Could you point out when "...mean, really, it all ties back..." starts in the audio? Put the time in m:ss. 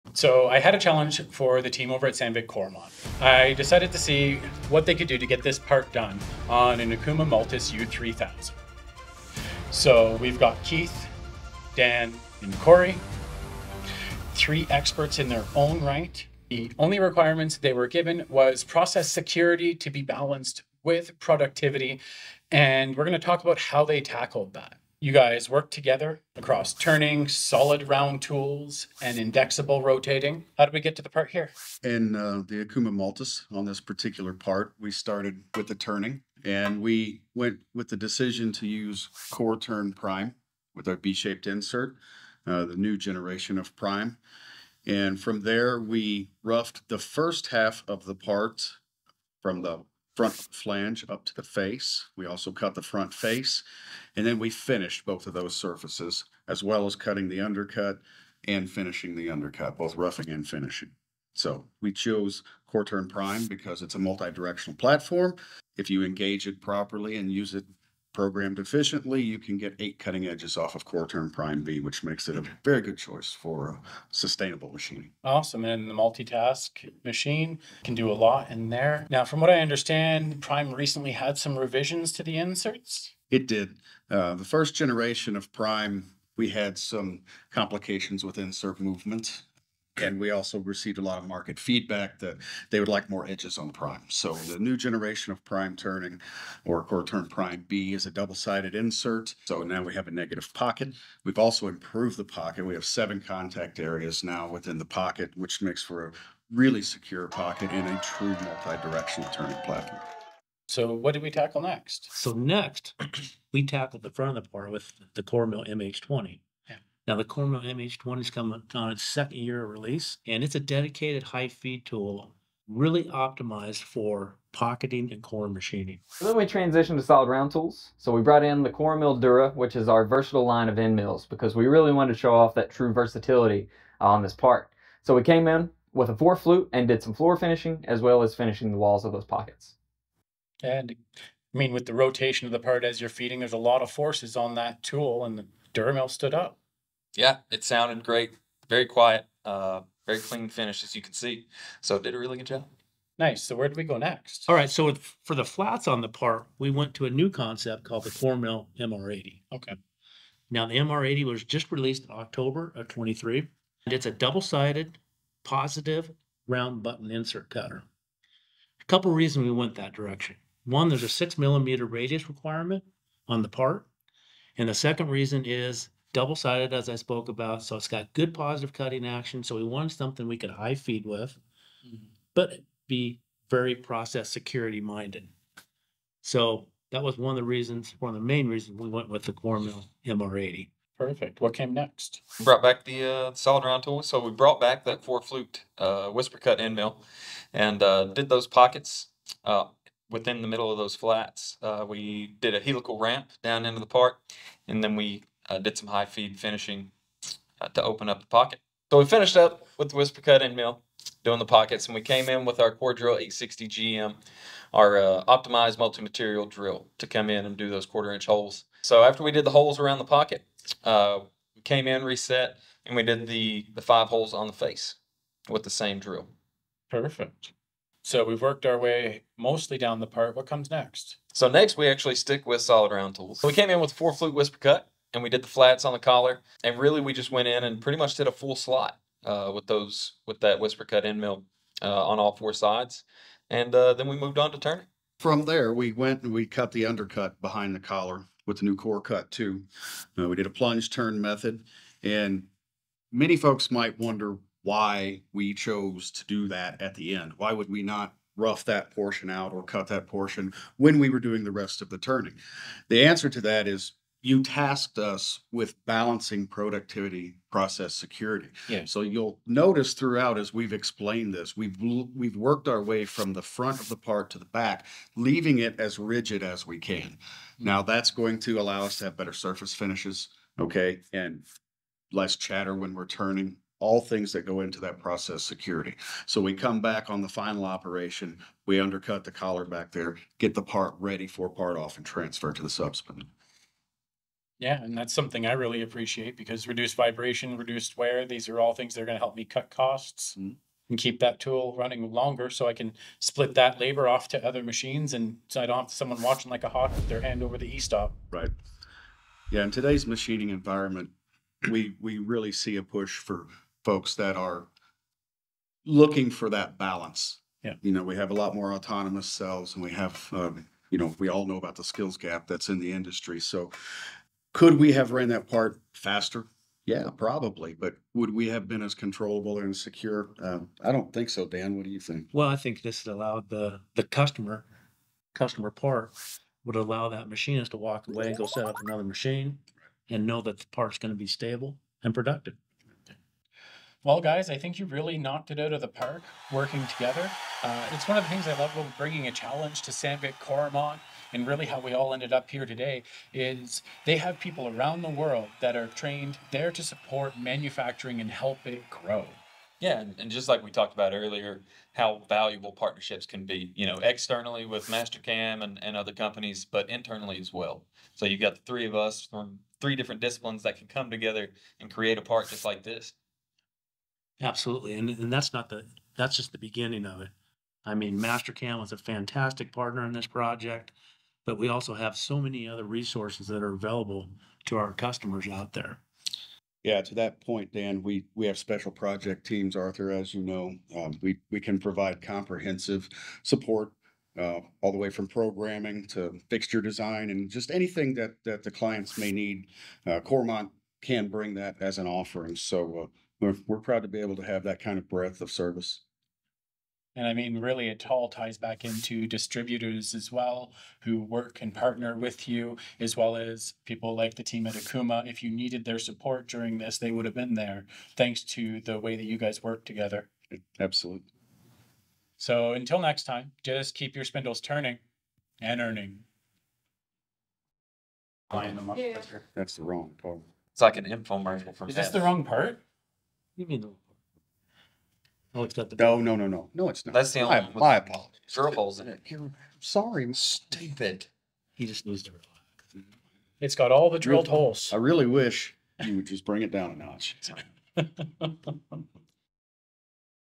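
6:47.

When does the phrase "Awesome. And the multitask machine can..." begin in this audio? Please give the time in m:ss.
1:15.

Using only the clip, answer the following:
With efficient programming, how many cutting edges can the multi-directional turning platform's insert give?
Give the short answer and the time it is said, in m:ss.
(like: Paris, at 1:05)
8, at 1:09.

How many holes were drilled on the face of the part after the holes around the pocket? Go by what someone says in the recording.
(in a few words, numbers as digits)
5.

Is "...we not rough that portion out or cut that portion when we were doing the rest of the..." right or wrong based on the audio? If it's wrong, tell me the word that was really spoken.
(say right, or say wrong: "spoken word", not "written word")
right.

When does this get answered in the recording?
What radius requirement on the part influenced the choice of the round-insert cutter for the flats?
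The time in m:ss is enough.
2:51.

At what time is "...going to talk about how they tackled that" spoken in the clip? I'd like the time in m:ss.
0:23.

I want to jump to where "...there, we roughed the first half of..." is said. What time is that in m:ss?
0:45.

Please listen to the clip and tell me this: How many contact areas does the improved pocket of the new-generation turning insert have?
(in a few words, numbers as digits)
7.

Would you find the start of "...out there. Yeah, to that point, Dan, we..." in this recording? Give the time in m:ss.
6:25.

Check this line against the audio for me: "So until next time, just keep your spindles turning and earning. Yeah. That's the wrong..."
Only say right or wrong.
right.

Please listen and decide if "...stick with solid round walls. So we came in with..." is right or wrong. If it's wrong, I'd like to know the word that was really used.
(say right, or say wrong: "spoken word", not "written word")
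wrong: "tools", not "walls".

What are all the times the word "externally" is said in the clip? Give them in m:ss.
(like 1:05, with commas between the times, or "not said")
6:04.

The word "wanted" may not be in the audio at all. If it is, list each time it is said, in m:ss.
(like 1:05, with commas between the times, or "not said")
2:11, 2:59.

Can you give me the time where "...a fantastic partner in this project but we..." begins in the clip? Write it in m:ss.
6:18.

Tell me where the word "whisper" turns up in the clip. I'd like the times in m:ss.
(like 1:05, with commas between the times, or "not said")
3:16, 3:29, 3:54, 4:00.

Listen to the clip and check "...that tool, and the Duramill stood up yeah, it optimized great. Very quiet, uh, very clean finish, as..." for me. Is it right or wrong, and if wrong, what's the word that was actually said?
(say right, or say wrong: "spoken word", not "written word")
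wrong: "sounded", not "optimized".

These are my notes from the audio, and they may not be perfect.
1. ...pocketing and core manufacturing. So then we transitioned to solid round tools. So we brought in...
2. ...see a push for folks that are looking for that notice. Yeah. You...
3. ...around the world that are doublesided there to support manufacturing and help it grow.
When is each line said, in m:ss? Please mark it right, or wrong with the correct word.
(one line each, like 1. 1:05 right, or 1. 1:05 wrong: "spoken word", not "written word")
1. 2:04 wrong: "machining", not "manufacturing"
2. 5:12 wrong: "balance", not "notice"
3. 5:54 wrong: "trained", not "doublesided".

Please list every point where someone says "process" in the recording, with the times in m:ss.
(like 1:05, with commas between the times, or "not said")
0:18, 3:03, 4:27, 4:44.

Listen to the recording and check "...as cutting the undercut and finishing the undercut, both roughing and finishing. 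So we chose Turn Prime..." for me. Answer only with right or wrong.
right.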